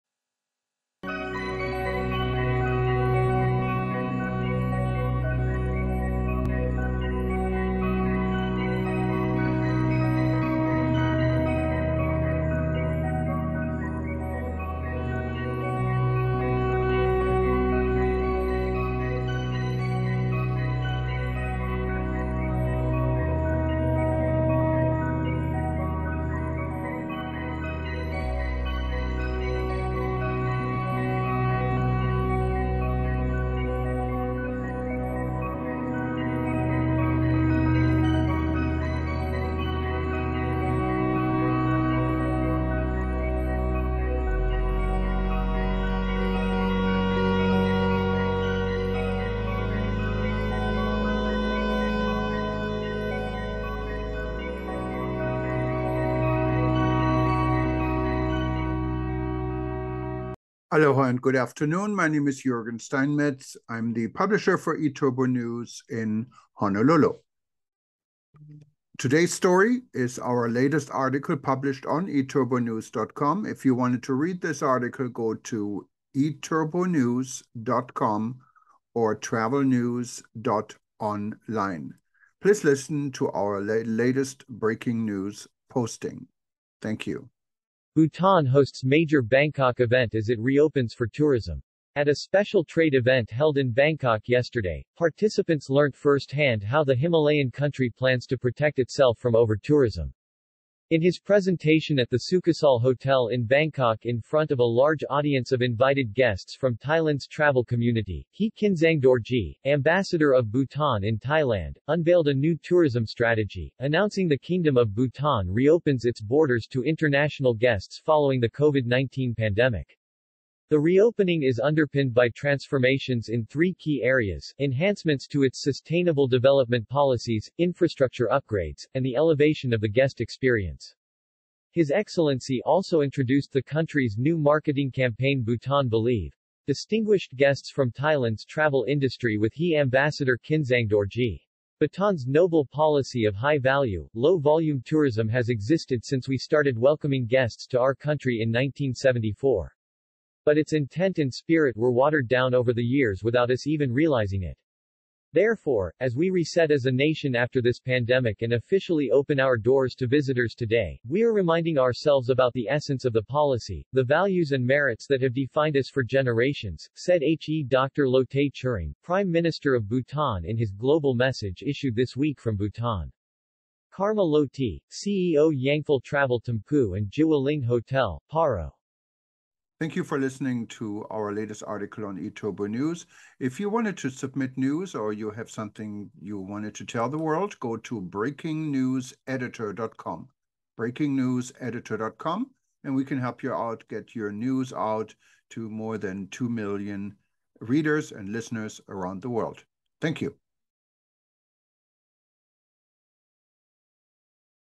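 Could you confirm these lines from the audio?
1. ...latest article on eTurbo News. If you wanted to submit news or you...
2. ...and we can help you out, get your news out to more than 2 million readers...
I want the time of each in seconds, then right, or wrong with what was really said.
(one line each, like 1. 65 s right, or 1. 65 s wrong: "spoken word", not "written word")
1. 181 s right
2. 192 s right.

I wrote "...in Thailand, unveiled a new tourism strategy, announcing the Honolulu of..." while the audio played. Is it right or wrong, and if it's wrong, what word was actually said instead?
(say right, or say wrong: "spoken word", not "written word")
wrong: "Kingdom", not "Honolulu".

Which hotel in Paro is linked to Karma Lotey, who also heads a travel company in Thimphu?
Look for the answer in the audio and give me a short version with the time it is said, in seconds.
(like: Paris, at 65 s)
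Zhiwa Ling Hotel, at 177 s.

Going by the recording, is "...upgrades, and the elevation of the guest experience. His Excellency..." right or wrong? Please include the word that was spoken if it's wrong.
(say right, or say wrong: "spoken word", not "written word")
right.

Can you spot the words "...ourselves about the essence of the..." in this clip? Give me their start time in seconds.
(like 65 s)
161 s.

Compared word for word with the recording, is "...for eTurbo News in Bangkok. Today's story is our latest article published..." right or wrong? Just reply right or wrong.
wrong.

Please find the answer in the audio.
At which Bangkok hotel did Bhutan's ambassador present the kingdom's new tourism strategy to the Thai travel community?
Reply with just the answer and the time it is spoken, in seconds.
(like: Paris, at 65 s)
Sukhasal Hotel, at 102 s.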